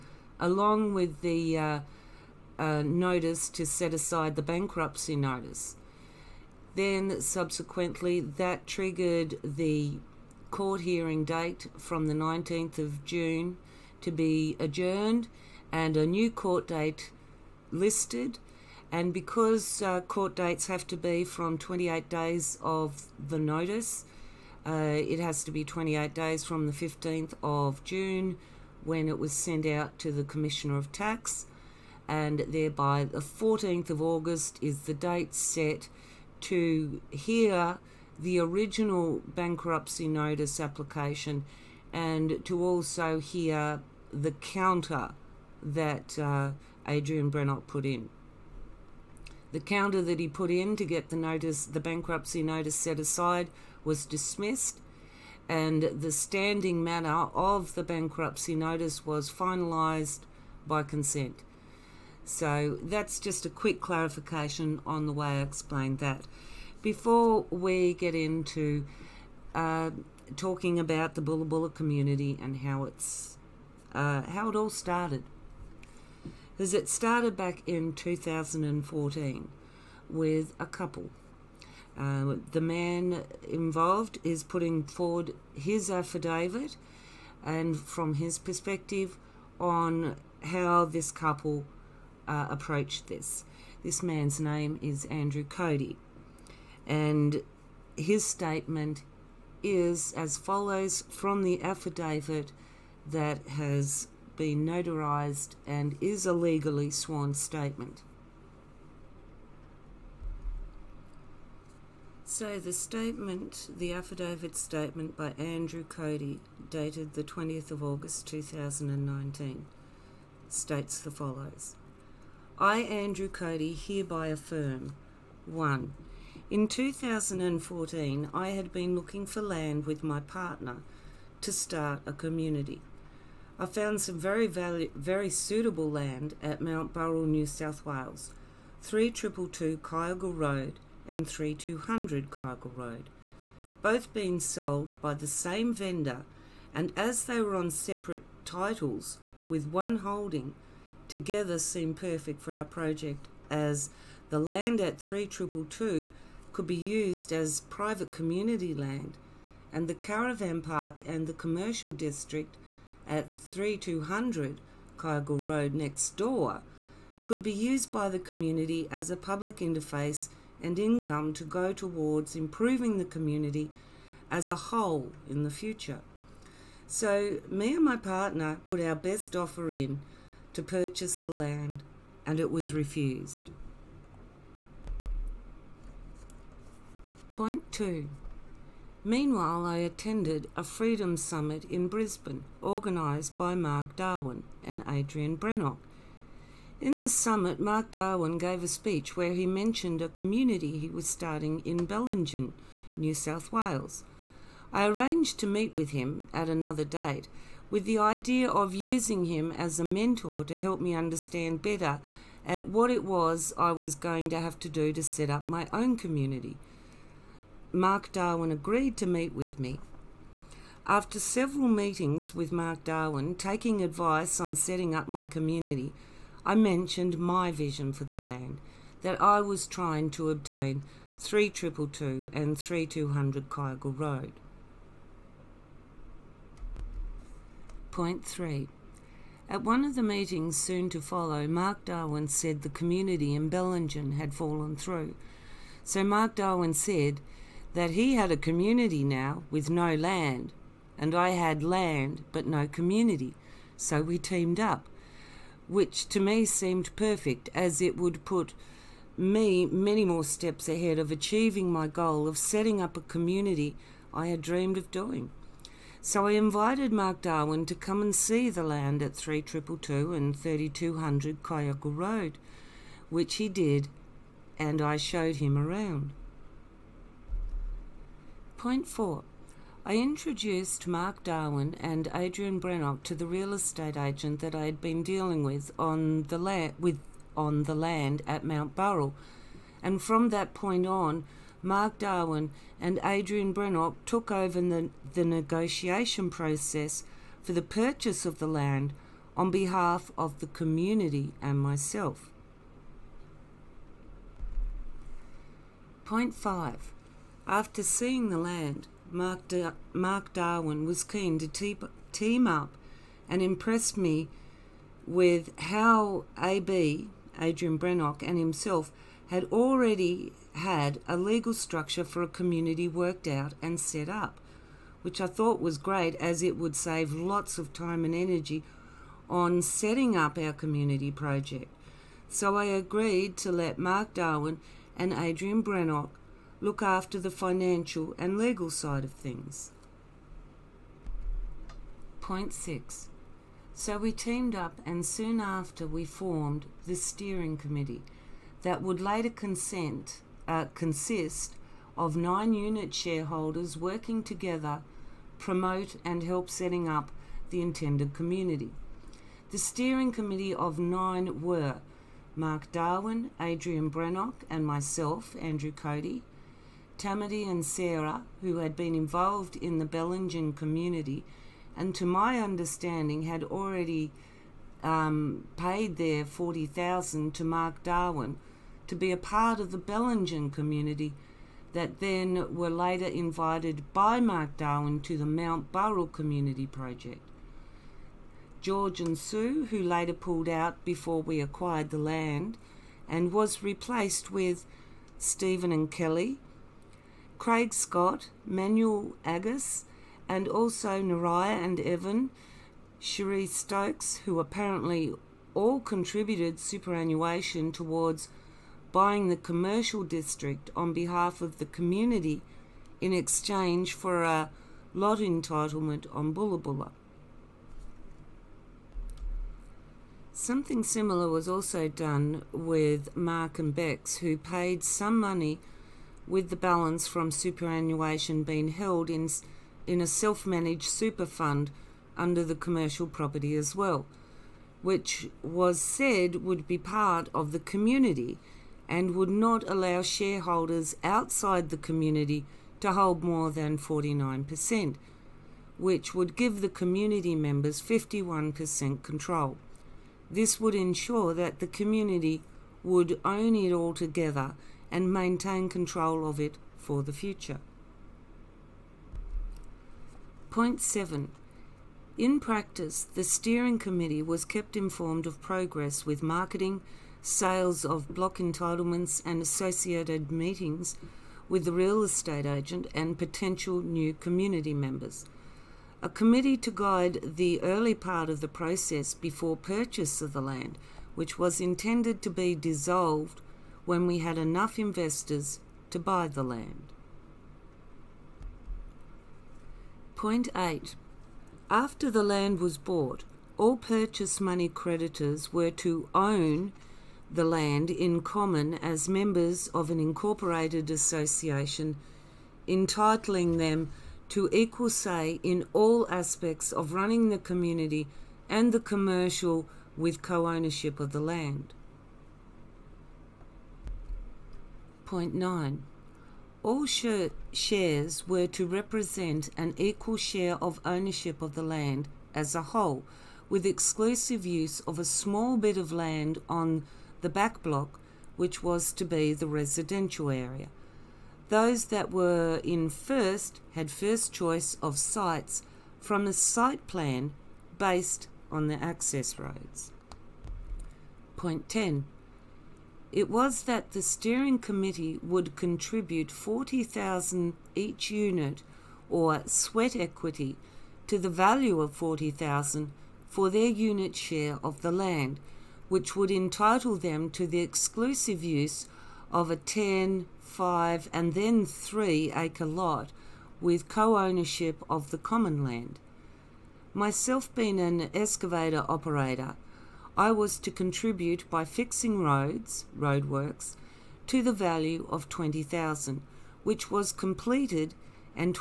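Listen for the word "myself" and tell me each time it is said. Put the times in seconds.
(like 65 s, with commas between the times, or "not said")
301 s, 364 s, 566 s.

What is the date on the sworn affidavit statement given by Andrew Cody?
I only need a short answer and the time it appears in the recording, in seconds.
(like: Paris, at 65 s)
20 August 2019, at 117 s.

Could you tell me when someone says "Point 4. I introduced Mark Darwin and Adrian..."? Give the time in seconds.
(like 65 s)
278 s.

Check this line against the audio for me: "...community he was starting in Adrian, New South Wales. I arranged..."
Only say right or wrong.
wrong.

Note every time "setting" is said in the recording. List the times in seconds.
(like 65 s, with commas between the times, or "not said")
224 s, 262 s, 329 s, 356 s.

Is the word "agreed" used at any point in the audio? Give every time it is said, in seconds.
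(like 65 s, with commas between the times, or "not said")
218 s, 332 s.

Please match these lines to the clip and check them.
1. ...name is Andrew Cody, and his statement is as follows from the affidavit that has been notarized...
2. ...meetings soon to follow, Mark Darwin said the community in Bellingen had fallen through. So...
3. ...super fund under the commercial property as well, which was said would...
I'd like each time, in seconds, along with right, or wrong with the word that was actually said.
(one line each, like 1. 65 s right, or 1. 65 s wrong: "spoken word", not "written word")
1. 94 s right
2. 240 s right
3. 430 s right.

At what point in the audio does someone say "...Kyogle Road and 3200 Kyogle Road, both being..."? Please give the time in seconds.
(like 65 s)
139 s.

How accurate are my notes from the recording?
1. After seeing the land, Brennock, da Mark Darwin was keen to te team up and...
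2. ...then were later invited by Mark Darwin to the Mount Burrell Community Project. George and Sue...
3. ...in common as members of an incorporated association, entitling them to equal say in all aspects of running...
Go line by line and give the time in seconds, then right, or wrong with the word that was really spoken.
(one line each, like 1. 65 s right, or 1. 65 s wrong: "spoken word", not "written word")
1. 307 s wrong: "Mark", not "Brennock"
2. 382 s right
3. 497 s right.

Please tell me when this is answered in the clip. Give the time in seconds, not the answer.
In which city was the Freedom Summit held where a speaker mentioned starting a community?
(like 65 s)
191 s.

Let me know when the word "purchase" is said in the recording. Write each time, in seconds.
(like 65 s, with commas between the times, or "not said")
180 s, 297 s, 479 s, 493 s.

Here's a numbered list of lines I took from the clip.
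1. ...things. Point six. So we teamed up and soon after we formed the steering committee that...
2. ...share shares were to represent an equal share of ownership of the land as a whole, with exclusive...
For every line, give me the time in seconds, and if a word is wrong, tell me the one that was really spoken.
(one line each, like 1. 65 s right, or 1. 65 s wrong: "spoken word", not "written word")
1. 339 s right
2. 516 s right.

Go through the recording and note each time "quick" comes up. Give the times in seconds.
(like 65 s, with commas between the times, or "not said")
63 s.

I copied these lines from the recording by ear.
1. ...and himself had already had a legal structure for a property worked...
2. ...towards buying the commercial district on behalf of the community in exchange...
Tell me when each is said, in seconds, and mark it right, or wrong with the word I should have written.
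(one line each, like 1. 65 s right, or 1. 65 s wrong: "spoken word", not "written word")
1. 318 s wrong: "community", not "property"
2. 407 s right.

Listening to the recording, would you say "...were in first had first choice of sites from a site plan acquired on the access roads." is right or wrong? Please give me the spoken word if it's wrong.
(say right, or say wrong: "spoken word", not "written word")
wrong: "based", not "acquired".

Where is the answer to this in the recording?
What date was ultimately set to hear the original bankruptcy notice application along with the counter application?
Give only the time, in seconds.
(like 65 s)
33 s.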